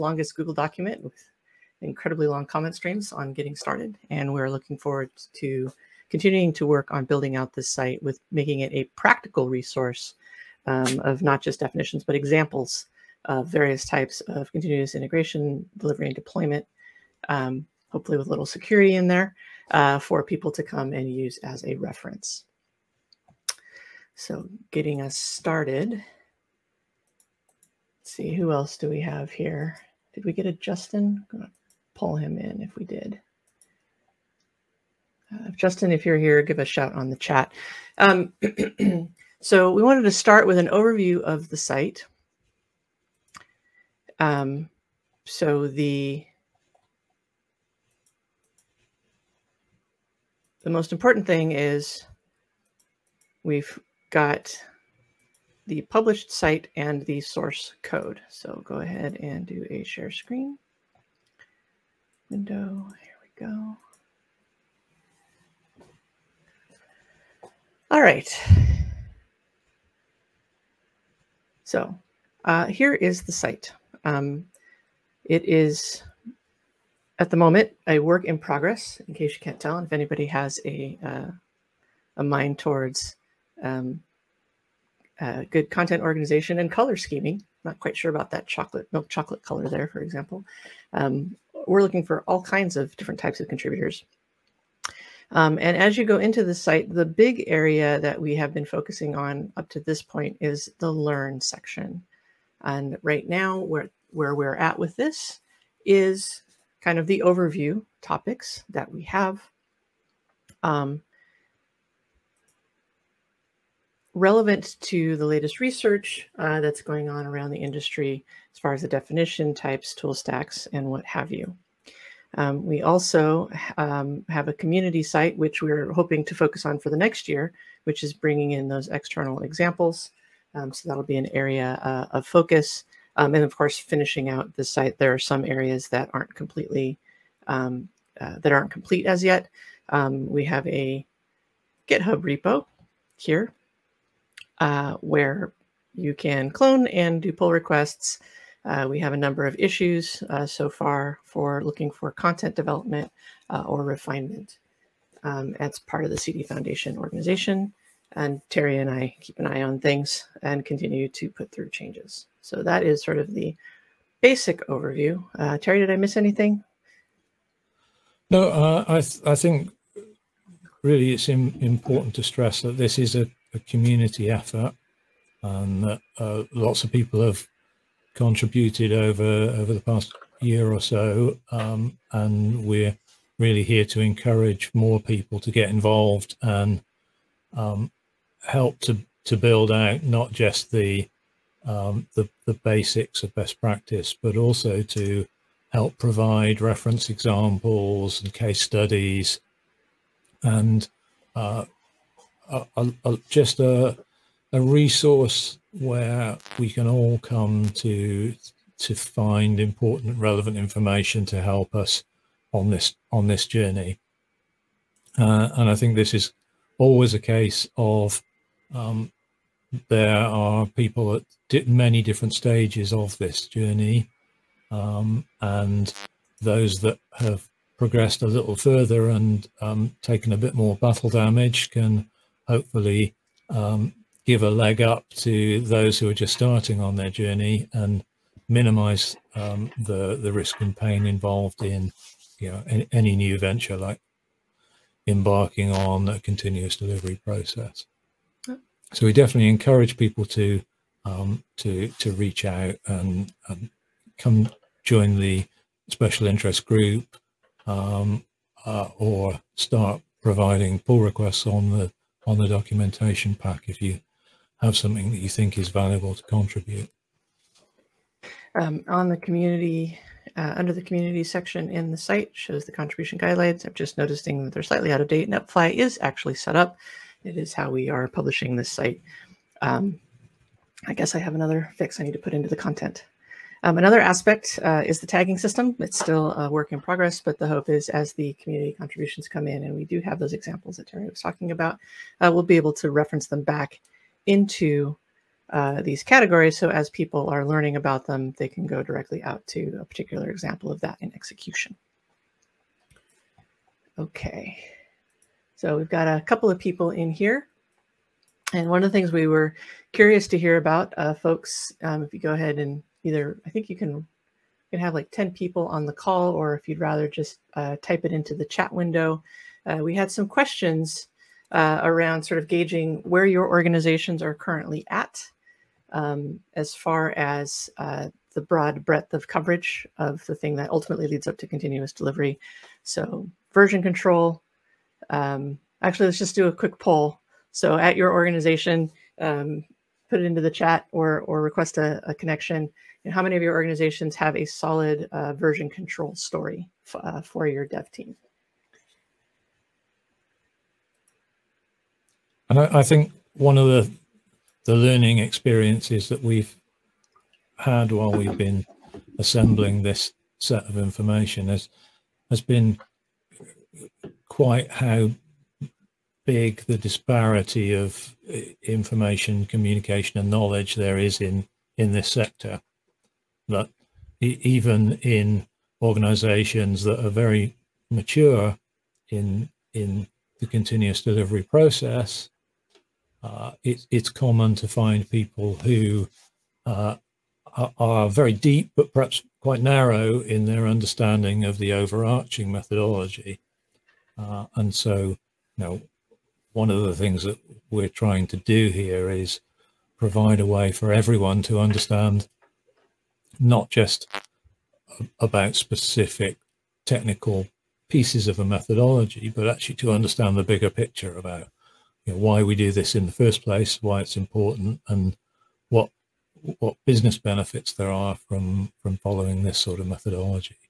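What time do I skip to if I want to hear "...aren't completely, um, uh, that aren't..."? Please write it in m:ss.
2:16.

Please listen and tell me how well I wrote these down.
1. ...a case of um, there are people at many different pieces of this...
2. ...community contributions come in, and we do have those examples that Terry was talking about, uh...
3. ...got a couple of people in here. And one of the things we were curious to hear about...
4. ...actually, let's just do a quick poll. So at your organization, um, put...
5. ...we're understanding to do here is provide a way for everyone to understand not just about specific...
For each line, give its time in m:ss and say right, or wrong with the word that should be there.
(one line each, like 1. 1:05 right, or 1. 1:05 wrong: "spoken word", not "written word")
1. 3:37 wrong: "stages", not "pieces"
2. 4:48 right
3. 5:05 right
4. 5:35 right
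5. 6:37 wrong: "trying", not "understanding".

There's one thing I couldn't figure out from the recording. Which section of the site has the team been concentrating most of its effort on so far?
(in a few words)
The learn section.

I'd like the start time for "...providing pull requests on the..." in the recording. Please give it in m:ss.
4:20.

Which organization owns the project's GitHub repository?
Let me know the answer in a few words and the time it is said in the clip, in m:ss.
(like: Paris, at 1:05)
CD Foundation, at 2:36.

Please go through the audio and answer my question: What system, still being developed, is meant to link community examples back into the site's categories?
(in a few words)
The tagging system.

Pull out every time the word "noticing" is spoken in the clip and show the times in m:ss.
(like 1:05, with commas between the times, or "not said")
4:33.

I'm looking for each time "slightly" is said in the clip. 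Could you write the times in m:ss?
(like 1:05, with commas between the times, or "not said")
4:34.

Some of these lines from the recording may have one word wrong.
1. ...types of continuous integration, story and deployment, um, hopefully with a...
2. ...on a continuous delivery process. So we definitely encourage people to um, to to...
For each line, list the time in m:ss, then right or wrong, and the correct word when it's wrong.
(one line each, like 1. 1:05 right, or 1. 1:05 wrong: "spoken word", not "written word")
1. 0:13 wrong: "delivery", not "story"
2. 4:05 right.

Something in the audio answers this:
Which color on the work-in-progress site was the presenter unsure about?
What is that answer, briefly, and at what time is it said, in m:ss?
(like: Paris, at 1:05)
Milk chocolate, at 1:28.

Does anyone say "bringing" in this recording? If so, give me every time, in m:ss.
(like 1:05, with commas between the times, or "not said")
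2:08.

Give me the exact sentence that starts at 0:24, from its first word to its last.
So getting us started, let's see, who else do we have here?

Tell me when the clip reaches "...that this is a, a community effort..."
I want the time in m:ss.
2:52.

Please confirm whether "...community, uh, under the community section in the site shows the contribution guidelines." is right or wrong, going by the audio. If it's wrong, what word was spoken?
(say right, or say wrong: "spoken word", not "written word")
right.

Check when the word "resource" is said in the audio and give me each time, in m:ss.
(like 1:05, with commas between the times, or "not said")
0:09, 3:24.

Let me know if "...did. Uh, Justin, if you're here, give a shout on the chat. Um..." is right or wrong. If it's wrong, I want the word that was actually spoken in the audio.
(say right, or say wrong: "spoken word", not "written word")
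right.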